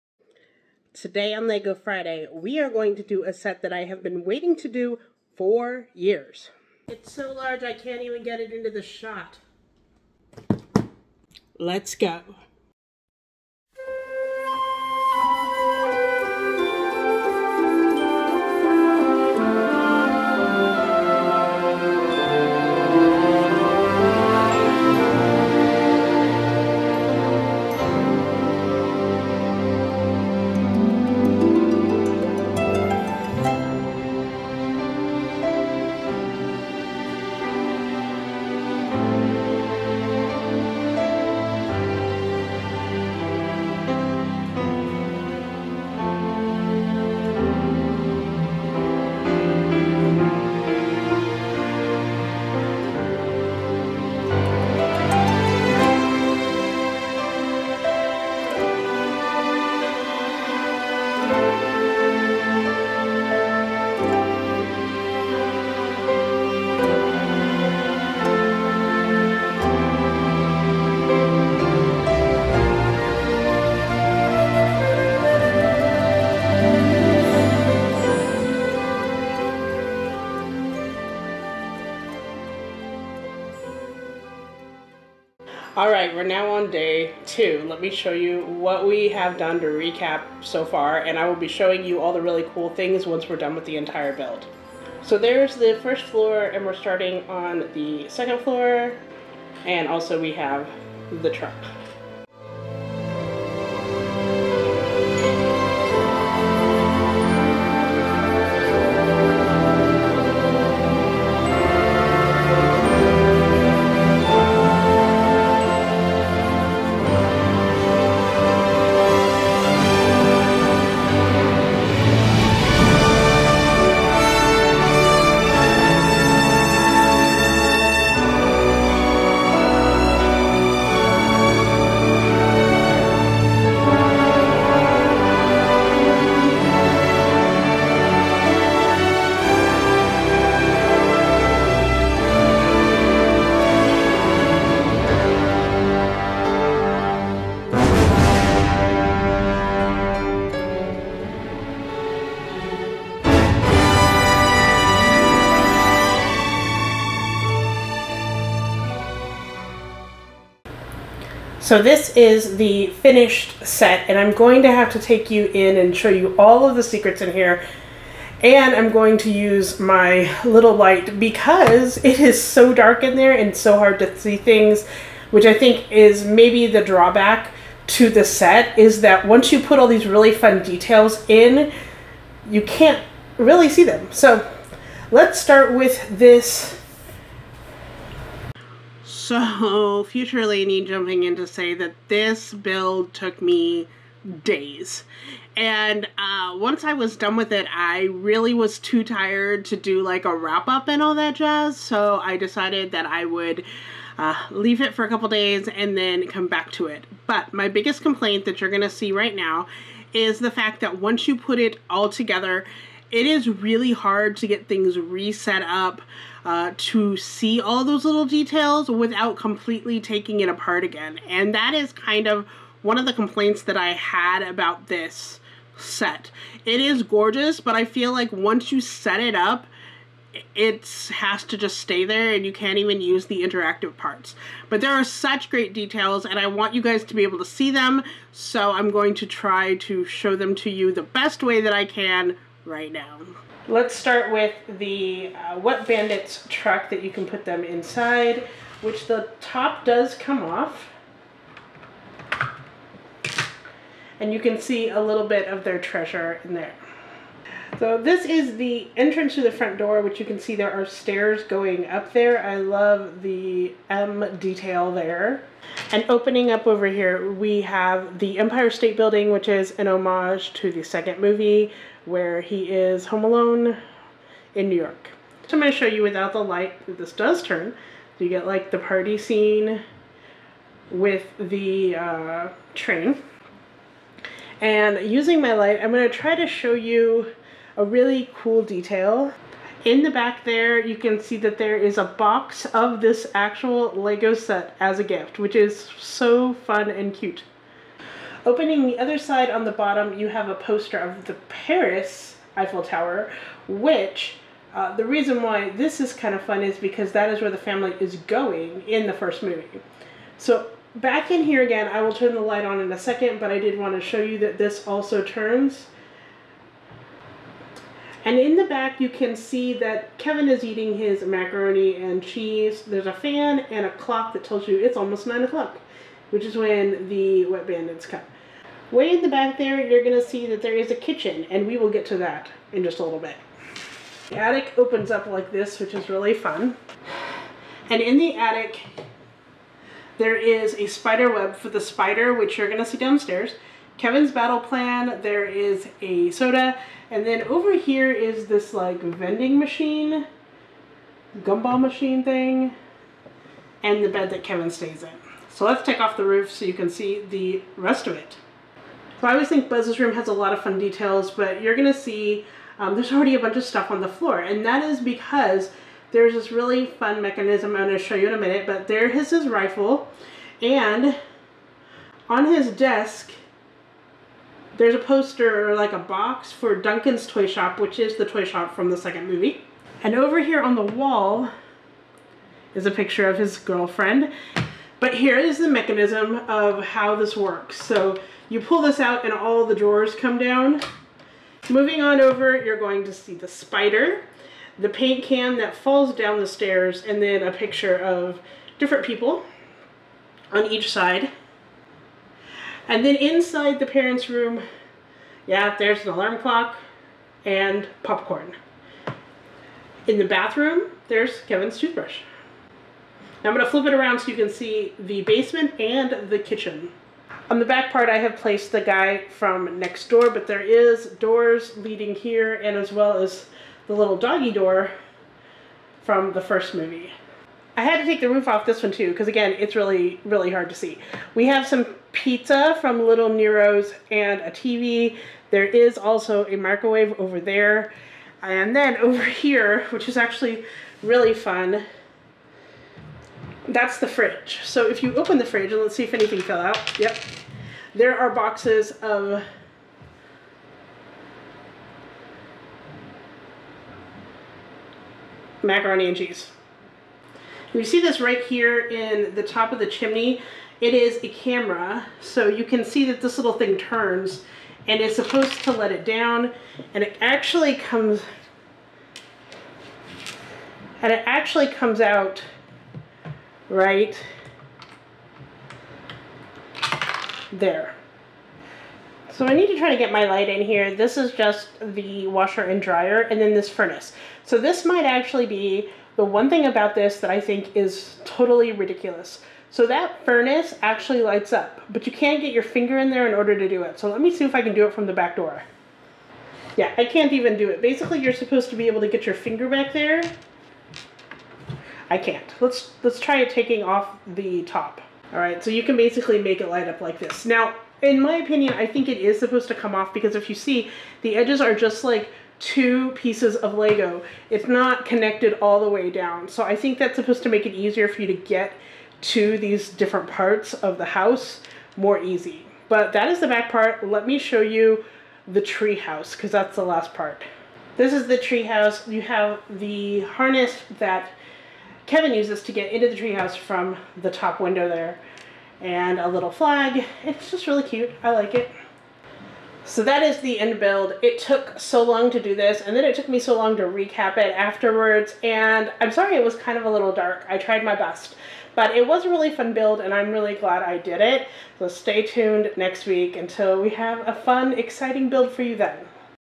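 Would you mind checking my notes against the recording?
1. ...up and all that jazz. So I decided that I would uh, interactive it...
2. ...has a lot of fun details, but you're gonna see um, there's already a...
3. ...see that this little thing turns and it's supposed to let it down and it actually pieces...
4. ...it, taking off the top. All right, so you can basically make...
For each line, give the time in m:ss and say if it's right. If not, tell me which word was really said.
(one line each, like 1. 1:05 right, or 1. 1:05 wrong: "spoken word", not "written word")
1. 3:20 wrong: "leave", not "interactive"
2. 6:00 right
3. 7:42 wrong: "comes", not "pieces"
4. 8:23 right.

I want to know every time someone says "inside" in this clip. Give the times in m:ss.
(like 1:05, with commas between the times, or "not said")
4:07, 6:43.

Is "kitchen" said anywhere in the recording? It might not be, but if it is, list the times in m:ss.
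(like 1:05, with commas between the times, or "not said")
5:30, 6:56.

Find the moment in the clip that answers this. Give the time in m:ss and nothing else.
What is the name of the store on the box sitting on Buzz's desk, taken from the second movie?
6:16.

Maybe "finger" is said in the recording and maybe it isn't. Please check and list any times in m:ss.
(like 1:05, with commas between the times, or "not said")
8:12, 8:19.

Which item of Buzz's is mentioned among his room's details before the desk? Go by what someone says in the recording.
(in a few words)
his rifle.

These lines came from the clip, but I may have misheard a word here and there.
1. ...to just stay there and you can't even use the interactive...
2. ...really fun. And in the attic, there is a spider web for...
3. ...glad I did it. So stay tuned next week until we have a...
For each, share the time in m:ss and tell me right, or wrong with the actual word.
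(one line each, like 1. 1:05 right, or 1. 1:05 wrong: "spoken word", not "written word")
1. 3:51 right
2. 5:36 right
3. 9:10 right.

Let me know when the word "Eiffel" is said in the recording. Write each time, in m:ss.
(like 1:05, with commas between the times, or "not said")
5:02.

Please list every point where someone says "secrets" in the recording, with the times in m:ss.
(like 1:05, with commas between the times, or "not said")
2:46.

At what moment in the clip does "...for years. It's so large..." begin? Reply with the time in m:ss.
0:05.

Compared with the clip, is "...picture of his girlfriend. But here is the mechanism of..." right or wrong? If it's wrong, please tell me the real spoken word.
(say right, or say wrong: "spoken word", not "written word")
right.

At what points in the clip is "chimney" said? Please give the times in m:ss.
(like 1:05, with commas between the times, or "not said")
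7:39.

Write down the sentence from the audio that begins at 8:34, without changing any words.
It's not connected all the way down.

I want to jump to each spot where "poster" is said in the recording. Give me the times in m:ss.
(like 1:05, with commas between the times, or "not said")
5:00, 6:14.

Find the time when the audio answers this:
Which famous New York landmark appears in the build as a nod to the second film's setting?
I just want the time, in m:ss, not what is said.
4:28.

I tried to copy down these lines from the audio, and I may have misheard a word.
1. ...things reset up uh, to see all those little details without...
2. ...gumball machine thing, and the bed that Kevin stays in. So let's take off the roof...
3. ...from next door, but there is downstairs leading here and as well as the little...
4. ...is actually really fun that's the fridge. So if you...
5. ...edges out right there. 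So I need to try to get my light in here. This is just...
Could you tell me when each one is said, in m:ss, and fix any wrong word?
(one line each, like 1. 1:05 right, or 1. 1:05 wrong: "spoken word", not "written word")
1. 3:34 right
2. 5:51 right
3. 6:59 wrong: "doors", not "downstairs"
4. 7:20 right
5. 7:51 wrong: "comes", not "edges".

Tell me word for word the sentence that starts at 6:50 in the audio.
In the bathroom, there's Kevin's toothbrush.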